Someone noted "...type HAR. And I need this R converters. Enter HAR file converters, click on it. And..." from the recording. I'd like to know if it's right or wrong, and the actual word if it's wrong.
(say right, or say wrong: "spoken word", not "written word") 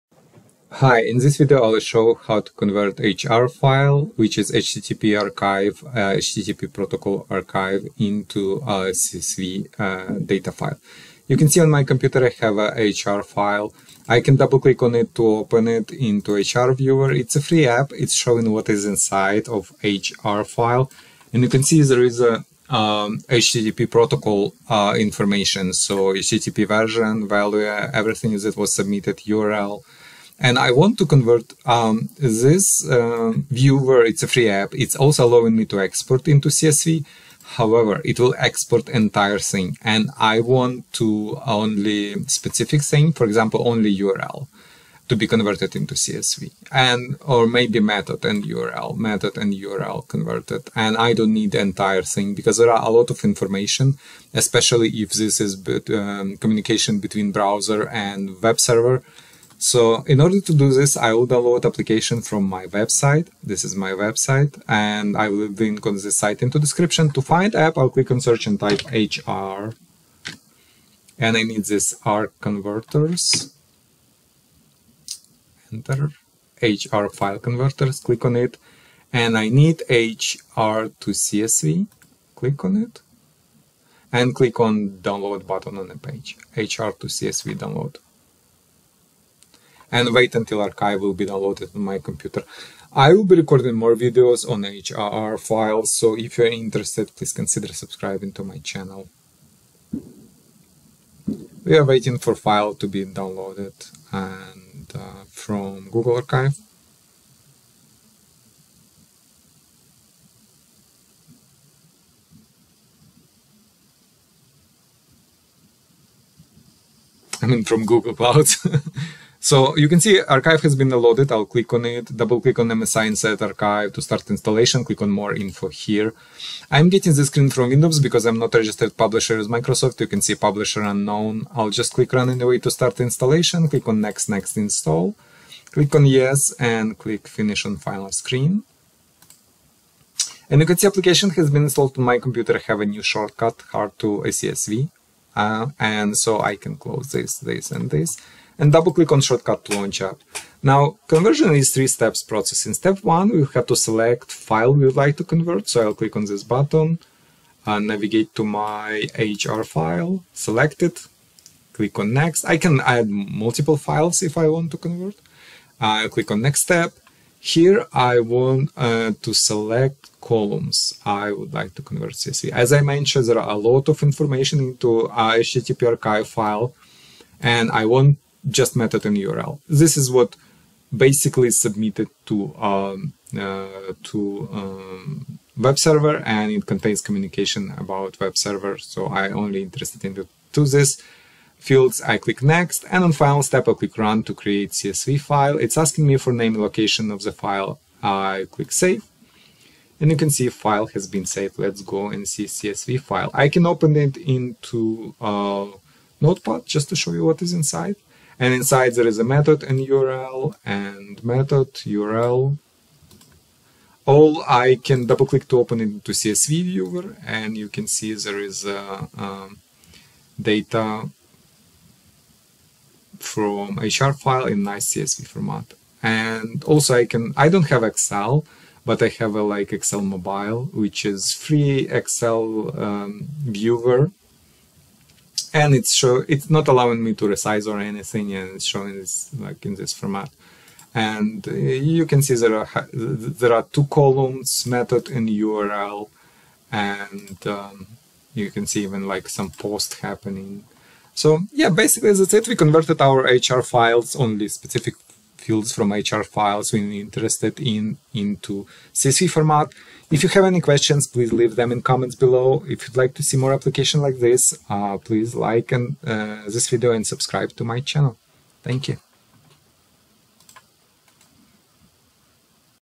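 right.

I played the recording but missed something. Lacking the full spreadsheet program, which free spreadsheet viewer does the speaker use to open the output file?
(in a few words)
Excel mobile.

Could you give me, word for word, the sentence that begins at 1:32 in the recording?
I will be recording more videos on HAR files, so if you're interested, please consider subscribing to my channel.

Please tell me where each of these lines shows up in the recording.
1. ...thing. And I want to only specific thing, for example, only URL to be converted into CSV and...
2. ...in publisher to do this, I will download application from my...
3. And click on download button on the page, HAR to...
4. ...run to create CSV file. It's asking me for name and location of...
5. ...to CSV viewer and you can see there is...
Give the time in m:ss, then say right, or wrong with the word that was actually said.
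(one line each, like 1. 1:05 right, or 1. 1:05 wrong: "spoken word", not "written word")
1. 0:39 right
2. 1:00 wrong: "order", not "publisher"
3. 1:24 right
4. 3:13 right
5. 3:36 right.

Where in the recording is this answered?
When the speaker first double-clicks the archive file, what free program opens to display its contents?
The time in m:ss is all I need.
0:16.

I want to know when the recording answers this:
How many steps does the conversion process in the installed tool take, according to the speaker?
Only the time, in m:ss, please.
2:31.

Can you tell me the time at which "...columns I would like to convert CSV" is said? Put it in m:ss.
2:50.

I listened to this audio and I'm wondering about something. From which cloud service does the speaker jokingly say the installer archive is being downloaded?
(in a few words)
Google Cloud.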